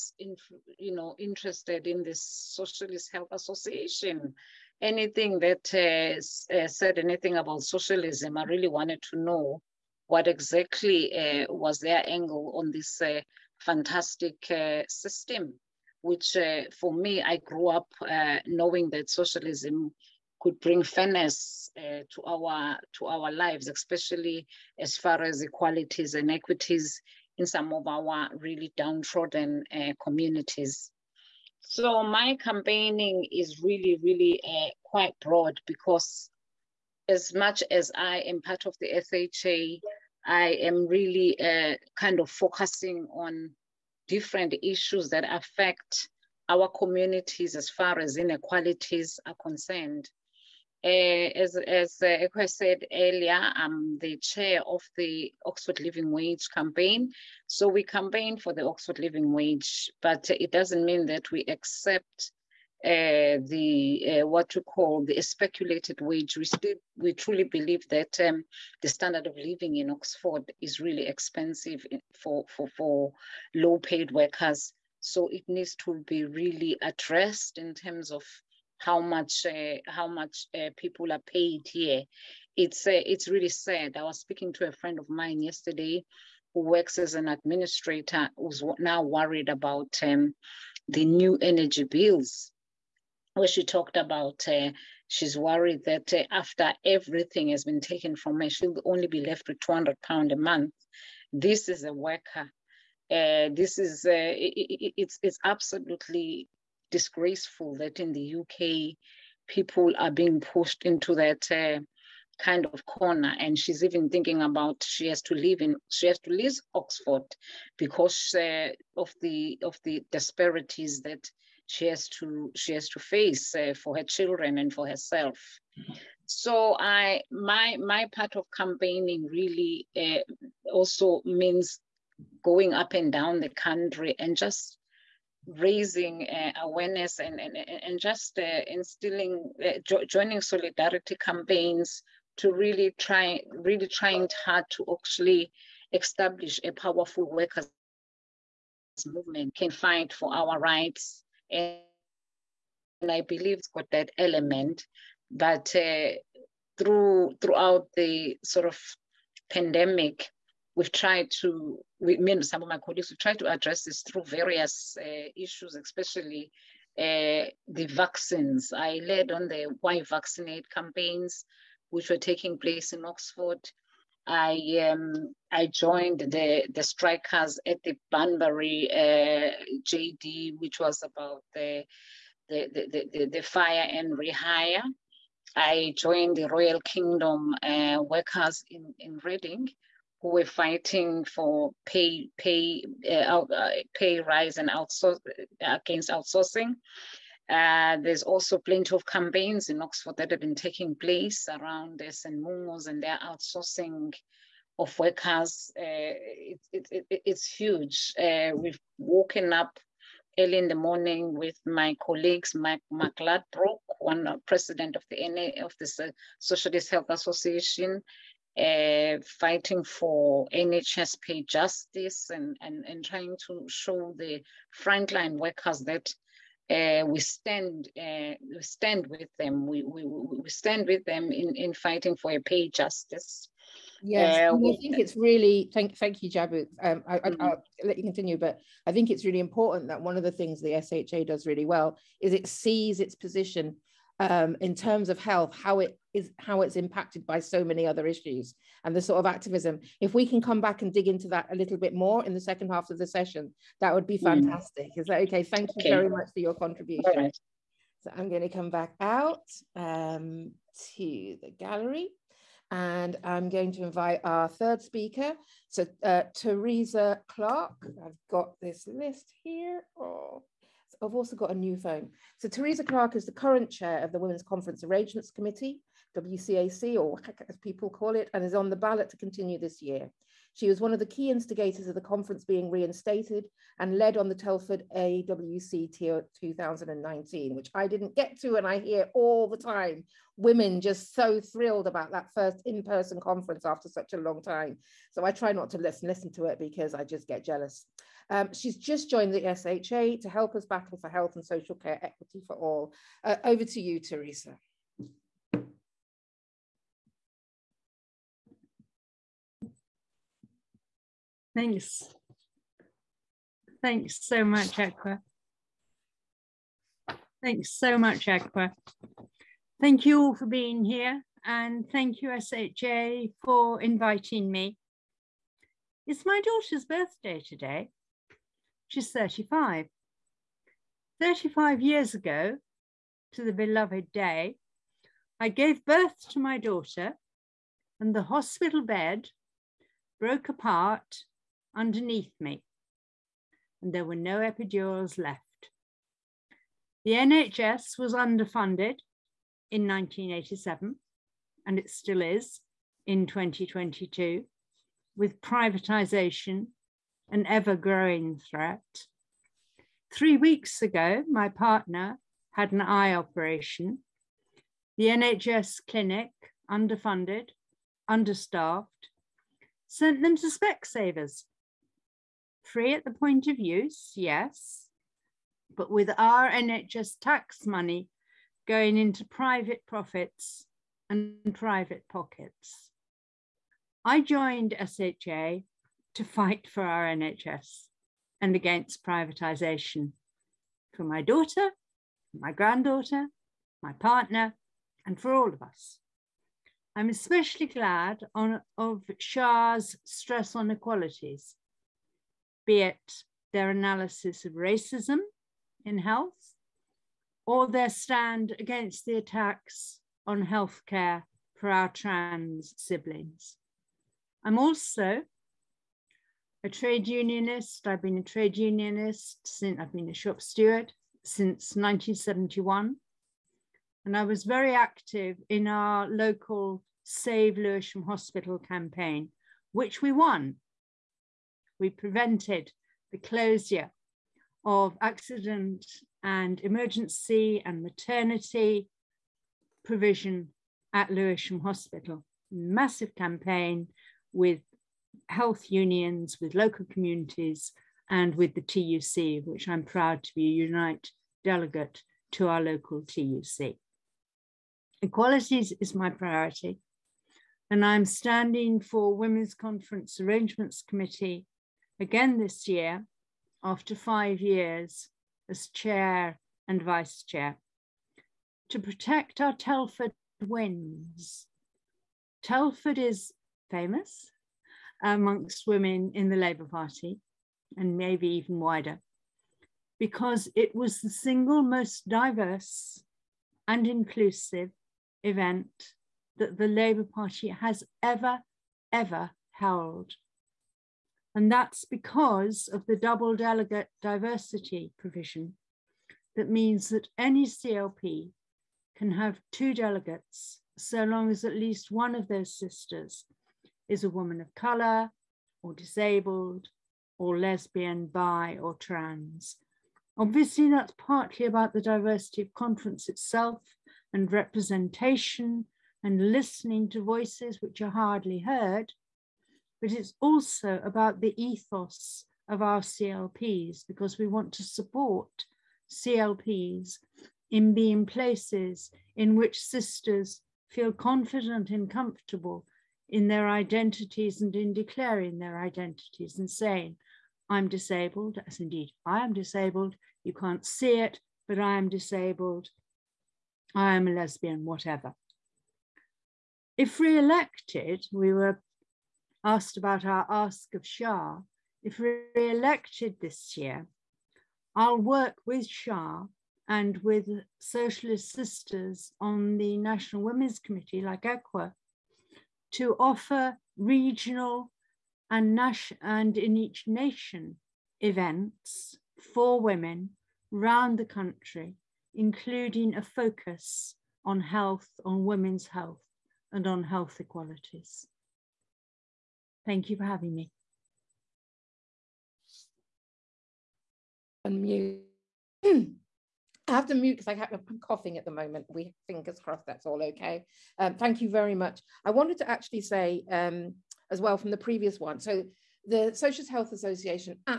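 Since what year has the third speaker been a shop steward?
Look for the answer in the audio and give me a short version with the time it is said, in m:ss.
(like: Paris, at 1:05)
1971, at 7:01.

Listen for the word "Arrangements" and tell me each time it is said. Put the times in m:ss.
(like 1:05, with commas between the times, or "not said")
4:34, 7:40.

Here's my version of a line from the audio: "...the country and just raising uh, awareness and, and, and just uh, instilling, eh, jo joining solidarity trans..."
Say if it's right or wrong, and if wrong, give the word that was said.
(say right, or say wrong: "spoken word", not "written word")
wrong: "campaigns", not "trans".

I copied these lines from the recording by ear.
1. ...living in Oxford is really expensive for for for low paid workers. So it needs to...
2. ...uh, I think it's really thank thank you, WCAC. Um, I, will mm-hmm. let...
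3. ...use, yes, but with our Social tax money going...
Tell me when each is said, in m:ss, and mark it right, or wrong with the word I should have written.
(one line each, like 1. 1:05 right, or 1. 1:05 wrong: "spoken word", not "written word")
1. 1:09 right
2. 3:54 wrong: "Jabu", not "WCAC"
3. 6:13 wrong: "NHS", not "Social".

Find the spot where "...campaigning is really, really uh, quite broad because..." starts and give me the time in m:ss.
0:32.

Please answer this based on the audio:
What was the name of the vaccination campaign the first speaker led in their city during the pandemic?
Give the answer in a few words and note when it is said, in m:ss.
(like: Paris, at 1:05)
Why Vaccinate, at 2:49.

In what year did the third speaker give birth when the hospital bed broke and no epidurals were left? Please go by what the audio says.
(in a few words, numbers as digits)
1987.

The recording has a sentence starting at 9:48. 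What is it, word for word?
We fingers crossed that's all okay.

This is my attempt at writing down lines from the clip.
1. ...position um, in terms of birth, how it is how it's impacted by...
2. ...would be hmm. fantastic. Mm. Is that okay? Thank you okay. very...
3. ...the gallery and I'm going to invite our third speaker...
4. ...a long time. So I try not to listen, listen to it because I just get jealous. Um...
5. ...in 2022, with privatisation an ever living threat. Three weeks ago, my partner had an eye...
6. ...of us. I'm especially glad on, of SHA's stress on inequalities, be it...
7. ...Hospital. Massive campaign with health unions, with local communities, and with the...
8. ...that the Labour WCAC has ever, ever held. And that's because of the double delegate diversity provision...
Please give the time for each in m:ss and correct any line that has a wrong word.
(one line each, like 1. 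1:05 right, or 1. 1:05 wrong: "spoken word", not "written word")
1. 4:03 wrong: "health", not "birth"
2. 4:13 right
3. 4:21 right
4. 4:54 right
5. 5:53 wrong: "growing", not "living"
6. 6:35 right
7. 7:21 right
8. 8:06 wrong: "Party", not "WCAC".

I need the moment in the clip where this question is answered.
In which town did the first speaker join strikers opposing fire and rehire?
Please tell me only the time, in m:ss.
2:58.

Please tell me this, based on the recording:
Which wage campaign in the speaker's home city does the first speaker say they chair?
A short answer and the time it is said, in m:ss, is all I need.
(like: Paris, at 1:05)
Oxford Living Wage campaign, at 0:55.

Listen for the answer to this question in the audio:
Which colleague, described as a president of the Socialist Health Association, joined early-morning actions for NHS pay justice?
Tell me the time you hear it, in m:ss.
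3:32.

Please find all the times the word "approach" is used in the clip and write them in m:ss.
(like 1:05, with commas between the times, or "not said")
not said.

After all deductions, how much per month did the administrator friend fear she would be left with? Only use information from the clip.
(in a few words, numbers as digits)
£200.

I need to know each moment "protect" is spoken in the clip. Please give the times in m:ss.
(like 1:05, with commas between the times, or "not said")
7:48.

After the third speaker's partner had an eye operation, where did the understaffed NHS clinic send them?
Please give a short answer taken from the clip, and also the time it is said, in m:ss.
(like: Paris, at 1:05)
Specsavers, at 6:10.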